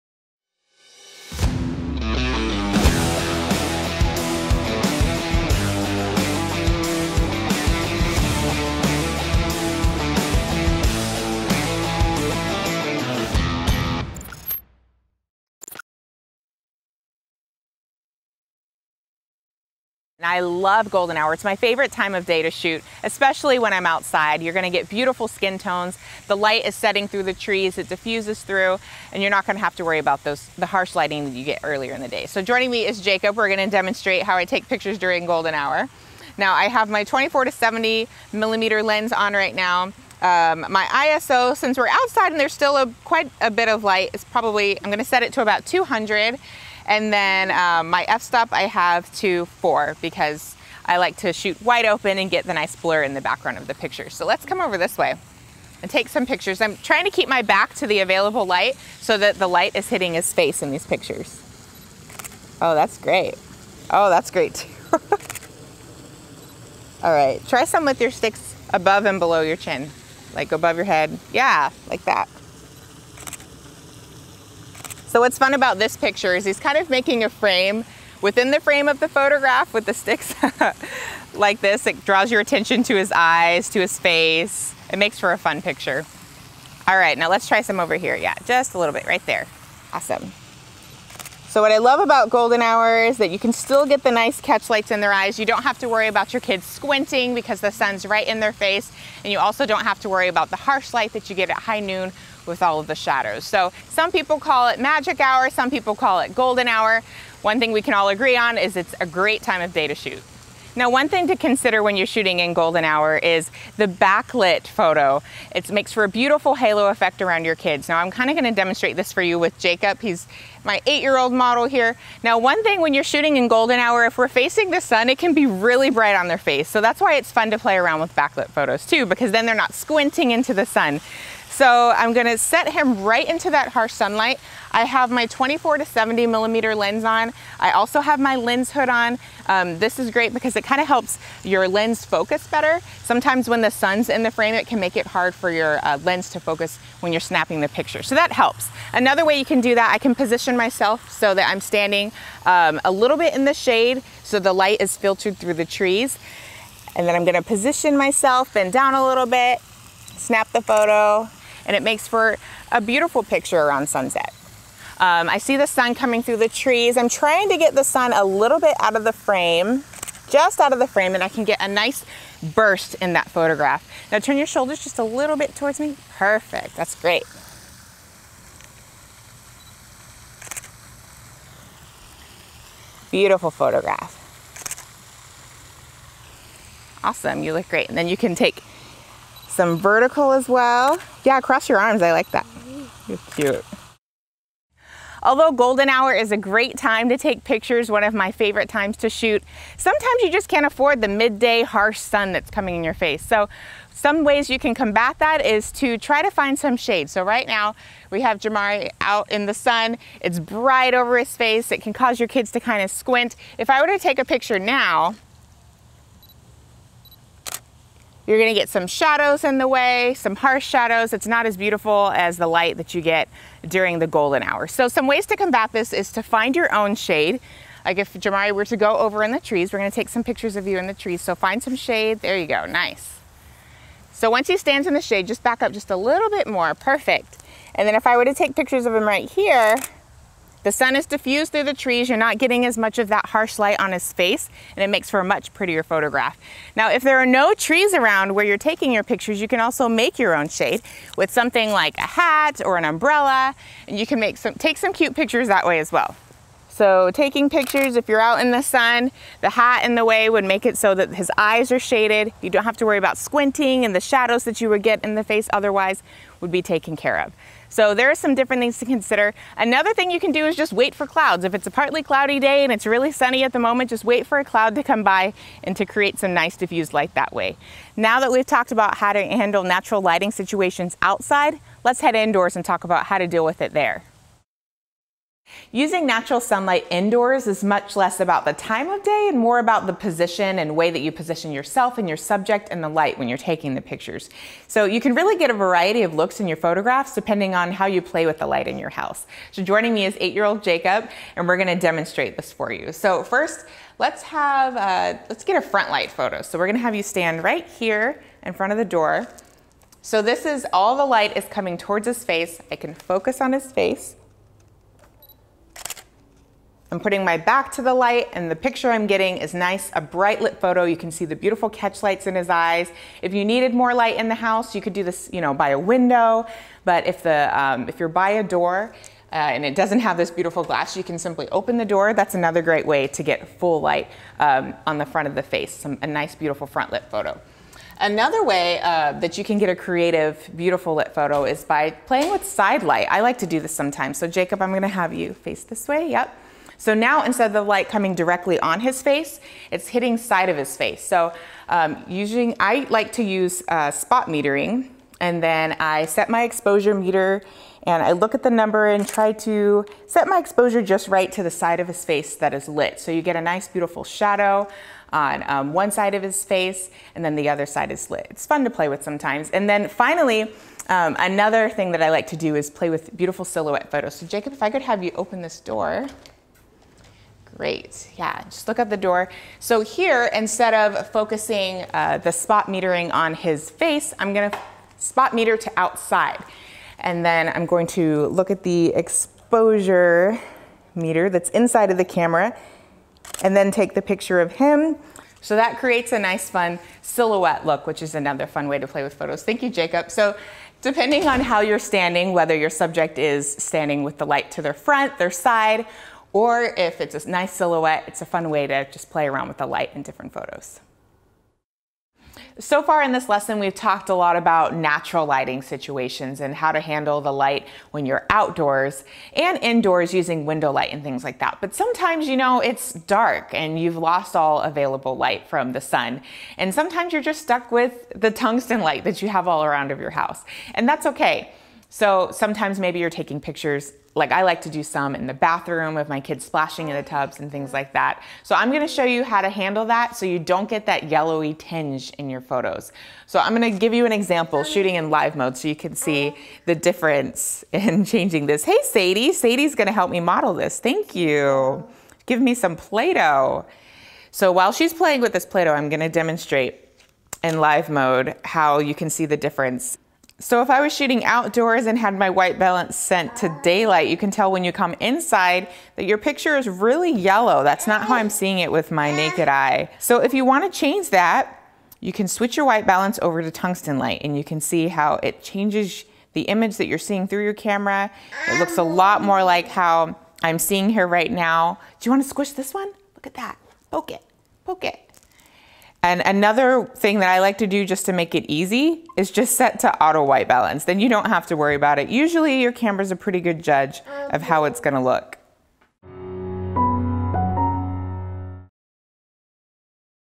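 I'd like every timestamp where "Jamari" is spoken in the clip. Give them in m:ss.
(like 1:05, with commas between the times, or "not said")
3:28, 3:48.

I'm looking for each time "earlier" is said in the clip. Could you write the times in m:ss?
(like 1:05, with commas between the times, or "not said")
0:31.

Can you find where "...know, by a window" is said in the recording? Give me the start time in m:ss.
5:25.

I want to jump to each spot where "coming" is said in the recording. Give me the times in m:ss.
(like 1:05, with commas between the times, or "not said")
2:45, 3:22, 5:11, 5:47.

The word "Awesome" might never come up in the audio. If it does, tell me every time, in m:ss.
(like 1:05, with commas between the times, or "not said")
1:29, 3:07.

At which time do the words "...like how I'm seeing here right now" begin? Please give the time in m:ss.
7:59.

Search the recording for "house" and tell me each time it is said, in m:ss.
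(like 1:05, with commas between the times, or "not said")
4:58, 5:24, 7:10.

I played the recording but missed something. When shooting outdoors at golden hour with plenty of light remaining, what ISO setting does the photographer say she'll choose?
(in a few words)
200.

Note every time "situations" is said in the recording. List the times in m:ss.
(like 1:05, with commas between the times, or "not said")
4:40, 6:55.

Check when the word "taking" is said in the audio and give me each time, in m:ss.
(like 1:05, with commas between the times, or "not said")
4:08, 4:17, 4:53, 7:13.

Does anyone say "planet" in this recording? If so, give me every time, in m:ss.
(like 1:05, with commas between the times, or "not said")
not said.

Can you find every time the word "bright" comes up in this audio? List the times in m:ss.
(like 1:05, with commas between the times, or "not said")
2:05, 3:30, 5:20.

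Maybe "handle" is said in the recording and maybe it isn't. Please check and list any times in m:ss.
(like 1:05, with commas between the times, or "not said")
4:39, 6:56, 7:19.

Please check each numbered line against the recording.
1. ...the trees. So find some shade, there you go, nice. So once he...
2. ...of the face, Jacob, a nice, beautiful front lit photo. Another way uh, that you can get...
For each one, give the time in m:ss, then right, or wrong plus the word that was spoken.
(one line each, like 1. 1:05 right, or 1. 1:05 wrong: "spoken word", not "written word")
1. 3:50 right
2. 5:35 wrong: "Some", not "Jacob".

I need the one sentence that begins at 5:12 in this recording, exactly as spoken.
I can focus on his face.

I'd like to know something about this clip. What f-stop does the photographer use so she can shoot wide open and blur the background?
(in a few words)
4.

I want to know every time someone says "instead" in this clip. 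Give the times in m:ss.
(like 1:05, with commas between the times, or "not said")
5:47, 6:20.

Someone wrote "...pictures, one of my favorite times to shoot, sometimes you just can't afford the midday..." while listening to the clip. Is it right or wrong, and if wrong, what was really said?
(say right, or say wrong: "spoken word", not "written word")
right.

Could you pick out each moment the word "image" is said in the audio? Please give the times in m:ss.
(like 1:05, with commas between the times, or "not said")
7:56.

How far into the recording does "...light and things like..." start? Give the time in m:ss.
7:00.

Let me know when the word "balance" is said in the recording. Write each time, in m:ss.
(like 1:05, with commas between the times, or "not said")
7:42, 7:52, 8:10.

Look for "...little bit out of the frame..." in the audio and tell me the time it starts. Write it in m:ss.
2:48.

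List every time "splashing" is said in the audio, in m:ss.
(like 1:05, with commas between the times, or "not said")
7:16.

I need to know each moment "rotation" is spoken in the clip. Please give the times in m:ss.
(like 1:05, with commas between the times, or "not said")
not said.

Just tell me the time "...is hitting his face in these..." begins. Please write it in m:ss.
0:59.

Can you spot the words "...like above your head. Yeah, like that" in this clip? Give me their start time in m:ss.
1:10.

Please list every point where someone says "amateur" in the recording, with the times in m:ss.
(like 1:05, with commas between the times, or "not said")
not said.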